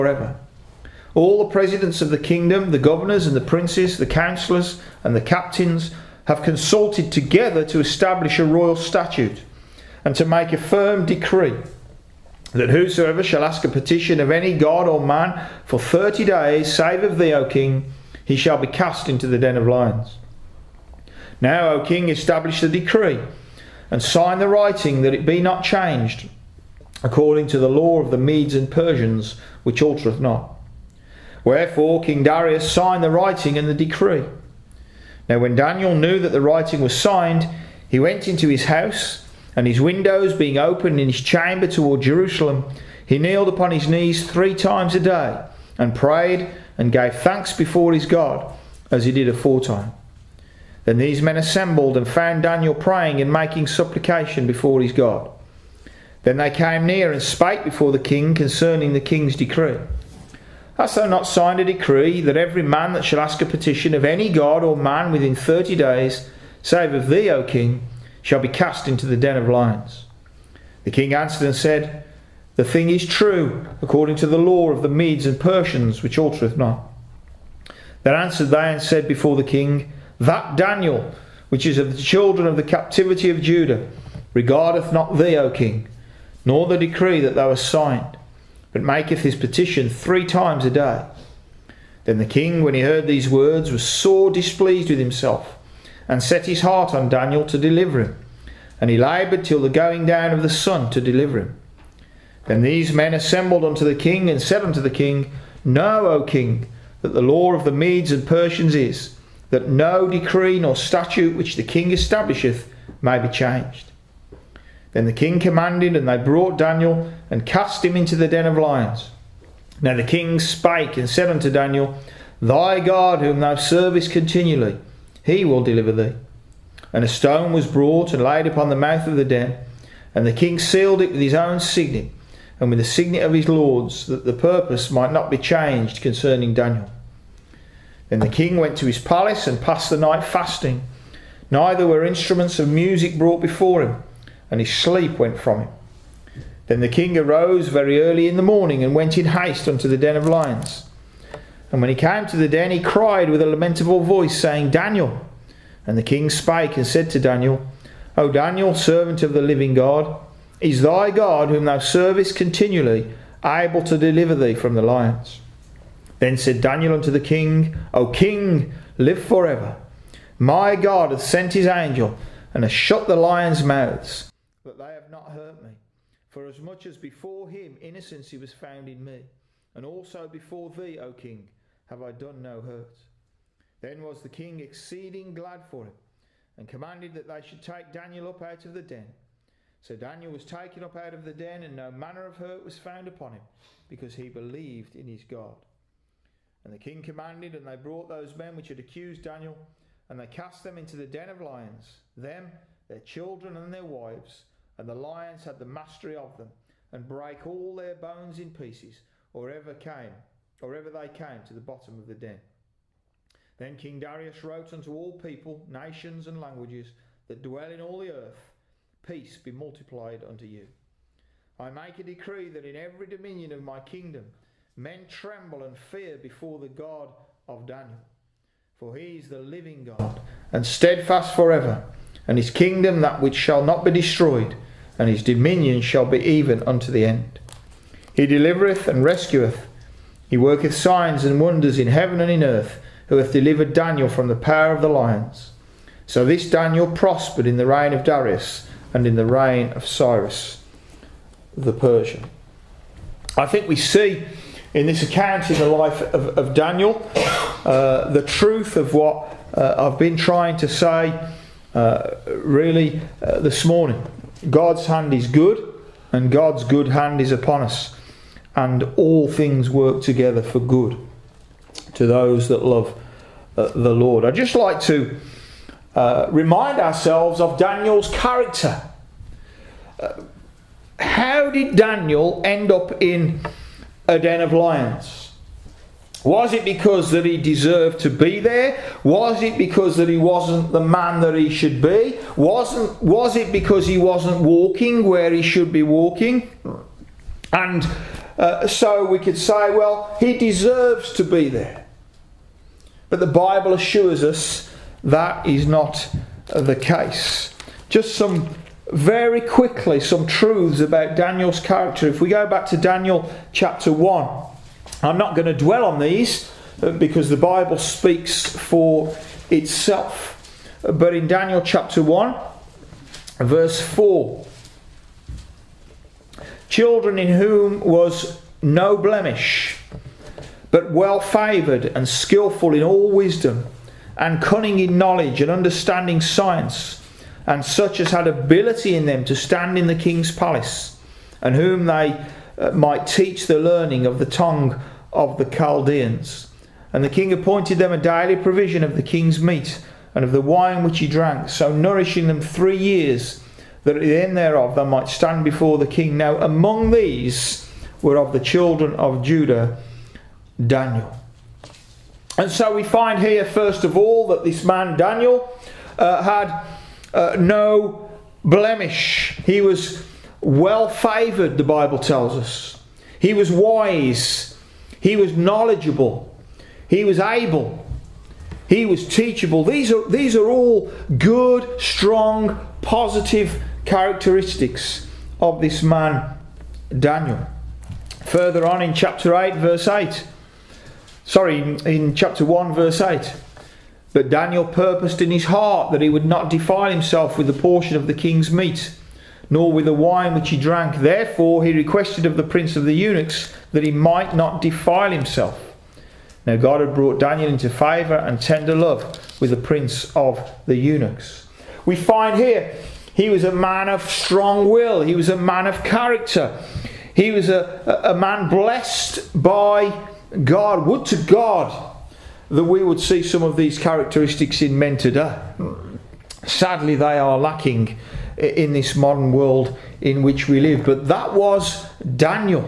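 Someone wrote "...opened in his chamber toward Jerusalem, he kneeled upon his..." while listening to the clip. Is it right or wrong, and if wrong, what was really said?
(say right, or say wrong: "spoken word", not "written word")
right.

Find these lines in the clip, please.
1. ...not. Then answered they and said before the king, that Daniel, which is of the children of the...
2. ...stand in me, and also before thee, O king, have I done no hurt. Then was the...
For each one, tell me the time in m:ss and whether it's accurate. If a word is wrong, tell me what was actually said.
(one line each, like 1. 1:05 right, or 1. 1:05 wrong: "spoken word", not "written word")
1. 1:16 right
2. 2:58 wrong: "found", not "stand".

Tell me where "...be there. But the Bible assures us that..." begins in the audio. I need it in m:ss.
5:01.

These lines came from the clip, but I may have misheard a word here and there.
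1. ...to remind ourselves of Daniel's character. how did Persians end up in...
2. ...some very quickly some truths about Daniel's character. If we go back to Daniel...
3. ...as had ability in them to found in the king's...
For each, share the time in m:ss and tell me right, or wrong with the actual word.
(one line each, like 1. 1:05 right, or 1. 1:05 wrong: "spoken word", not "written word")
1. 4:34 wrong: "Daniel", not "Persians"
2. 5:08 right
3. 5:38 wrong: "stand", not "found".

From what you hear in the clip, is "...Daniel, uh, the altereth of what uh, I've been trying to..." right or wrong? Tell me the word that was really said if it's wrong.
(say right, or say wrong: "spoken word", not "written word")
wrong: "truth", not "altereth".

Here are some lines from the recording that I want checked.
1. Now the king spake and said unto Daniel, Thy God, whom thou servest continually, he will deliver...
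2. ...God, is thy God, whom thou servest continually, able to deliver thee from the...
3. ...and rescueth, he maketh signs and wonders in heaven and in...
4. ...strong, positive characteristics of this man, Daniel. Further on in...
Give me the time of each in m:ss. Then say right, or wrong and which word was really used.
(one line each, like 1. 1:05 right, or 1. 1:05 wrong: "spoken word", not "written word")
1. 1:59 right
2. 2:39 right
3. 3:58 wrong: "worketh", not "maketh"
4. 6:21 right.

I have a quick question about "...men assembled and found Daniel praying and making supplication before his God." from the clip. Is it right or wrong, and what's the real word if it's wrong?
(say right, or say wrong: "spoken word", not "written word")
right.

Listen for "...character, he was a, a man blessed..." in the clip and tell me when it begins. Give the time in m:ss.
6:55.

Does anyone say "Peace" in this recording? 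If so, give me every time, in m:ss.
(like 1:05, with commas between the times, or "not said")
3:39.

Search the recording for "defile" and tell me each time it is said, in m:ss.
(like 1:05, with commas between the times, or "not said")
6:36, 6:44.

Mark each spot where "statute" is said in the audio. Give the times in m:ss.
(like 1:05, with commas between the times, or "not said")
0:08, 1:50.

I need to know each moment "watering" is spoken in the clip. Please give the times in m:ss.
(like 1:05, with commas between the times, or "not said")
not said.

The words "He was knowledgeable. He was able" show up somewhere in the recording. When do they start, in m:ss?
6:15.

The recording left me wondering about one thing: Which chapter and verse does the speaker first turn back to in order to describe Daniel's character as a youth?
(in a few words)
Daniel 1:4.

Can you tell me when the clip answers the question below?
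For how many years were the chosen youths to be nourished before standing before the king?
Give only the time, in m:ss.
5:52.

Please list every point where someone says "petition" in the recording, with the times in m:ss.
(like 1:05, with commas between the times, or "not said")
0:13, 1:03, 1:29.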